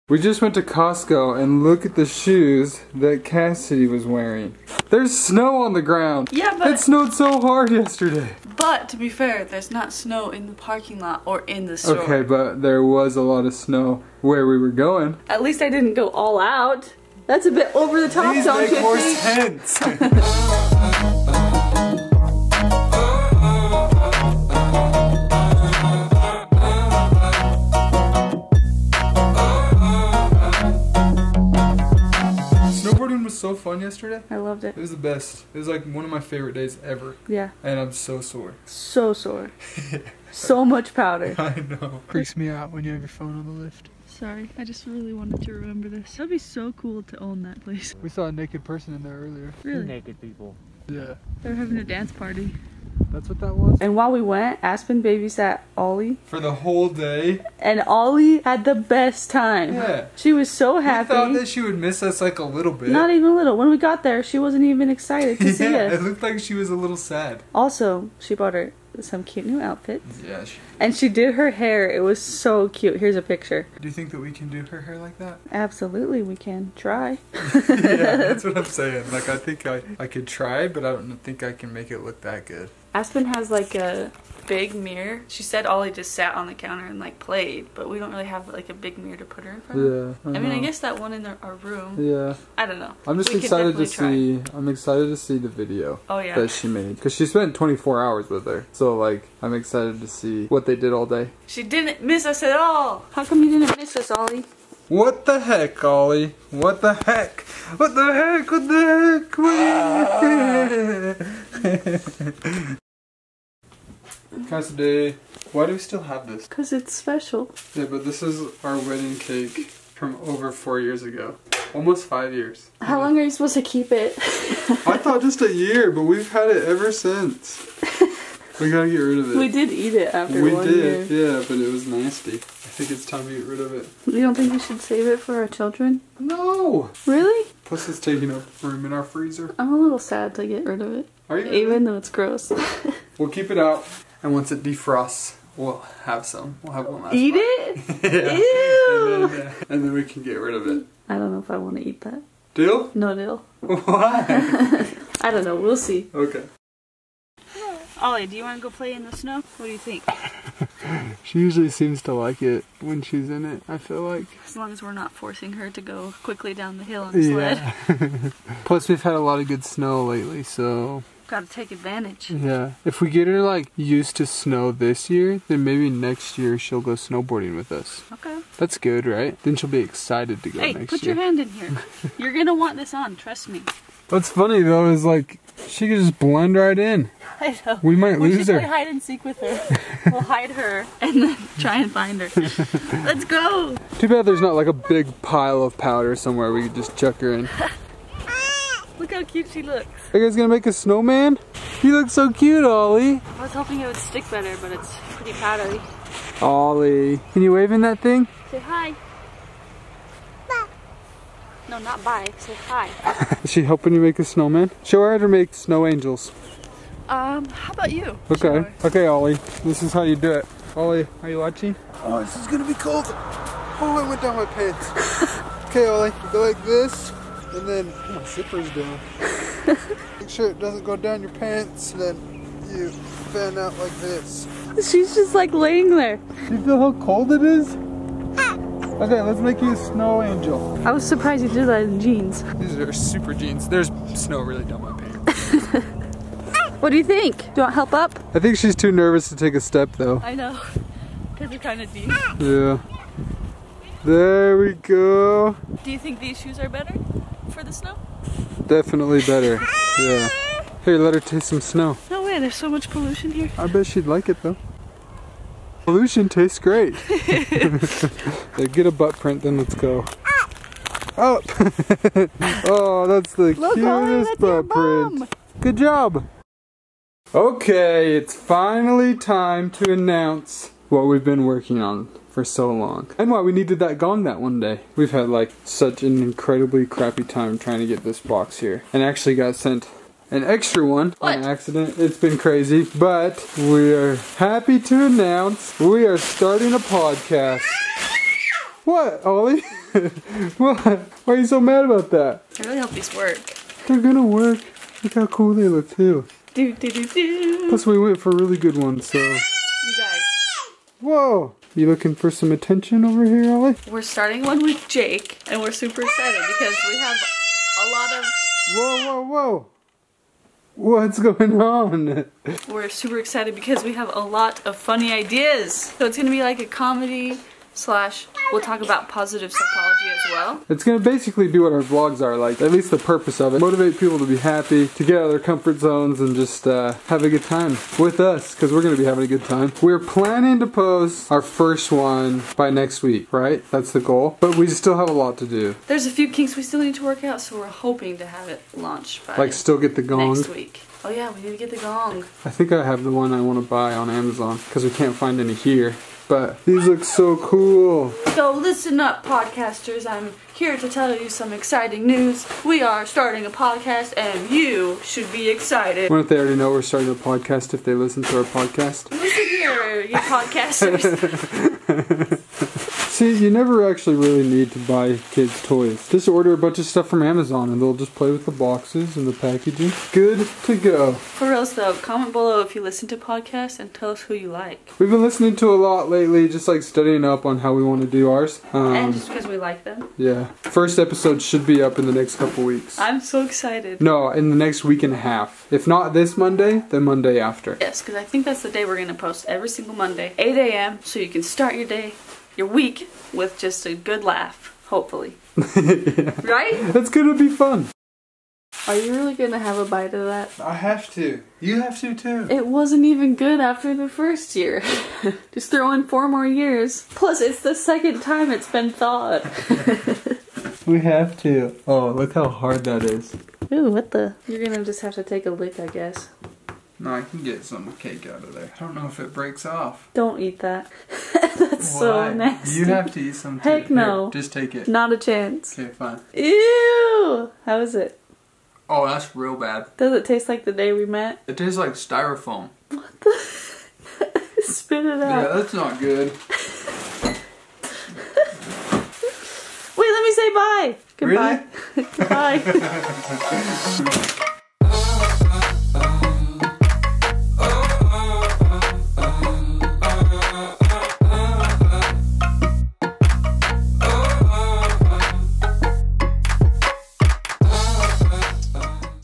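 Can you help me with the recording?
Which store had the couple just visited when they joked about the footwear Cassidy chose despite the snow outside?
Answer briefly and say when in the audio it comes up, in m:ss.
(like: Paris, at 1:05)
Costco, at 0:00.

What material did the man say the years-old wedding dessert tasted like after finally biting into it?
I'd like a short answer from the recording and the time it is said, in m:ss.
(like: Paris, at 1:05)
Styrofoam, at 7:21.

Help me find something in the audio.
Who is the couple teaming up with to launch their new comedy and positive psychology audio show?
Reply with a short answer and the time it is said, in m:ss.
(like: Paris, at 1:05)
Jake, at 5:14.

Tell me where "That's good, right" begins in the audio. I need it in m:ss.
2:58.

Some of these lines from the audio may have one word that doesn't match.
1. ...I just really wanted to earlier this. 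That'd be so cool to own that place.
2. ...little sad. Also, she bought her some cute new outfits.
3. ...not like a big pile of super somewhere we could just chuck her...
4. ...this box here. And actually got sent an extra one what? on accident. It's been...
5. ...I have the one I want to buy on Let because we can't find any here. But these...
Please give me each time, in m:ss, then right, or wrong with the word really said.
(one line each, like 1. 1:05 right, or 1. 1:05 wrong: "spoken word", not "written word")
1. 0:44 wrong: "remember", not "earlier"
2. 1:06 right
3. 3:14 wrong: "powder", not "super"
4. 4:48 right
5. 5:52 wrong: "Amazon", not "Let".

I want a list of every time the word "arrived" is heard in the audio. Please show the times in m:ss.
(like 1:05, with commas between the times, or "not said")
not said.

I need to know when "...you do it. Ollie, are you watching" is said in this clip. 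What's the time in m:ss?
3:40.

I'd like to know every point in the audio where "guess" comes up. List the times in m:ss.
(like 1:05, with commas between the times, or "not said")
1:30, 7:05.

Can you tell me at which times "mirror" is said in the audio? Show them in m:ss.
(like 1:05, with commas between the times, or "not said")
1:24, 1:28.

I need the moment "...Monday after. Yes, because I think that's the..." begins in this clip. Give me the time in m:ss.
6:37.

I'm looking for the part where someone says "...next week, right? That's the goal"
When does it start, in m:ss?
5:42.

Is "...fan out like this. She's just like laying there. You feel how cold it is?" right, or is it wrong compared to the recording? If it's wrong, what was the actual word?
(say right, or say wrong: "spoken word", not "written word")
right.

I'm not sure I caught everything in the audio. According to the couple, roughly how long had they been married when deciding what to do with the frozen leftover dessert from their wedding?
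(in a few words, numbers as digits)
almost 5 years.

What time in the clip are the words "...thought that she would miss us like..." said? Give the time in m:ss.
1:01.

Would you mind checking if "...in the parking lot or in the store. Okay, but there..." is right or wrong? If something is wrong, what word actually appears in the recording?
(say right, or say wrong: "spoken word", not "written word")
right.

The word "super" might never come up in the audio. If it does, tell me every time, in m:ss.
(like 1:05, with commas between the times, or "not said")
4:02, 5:15, 5:22.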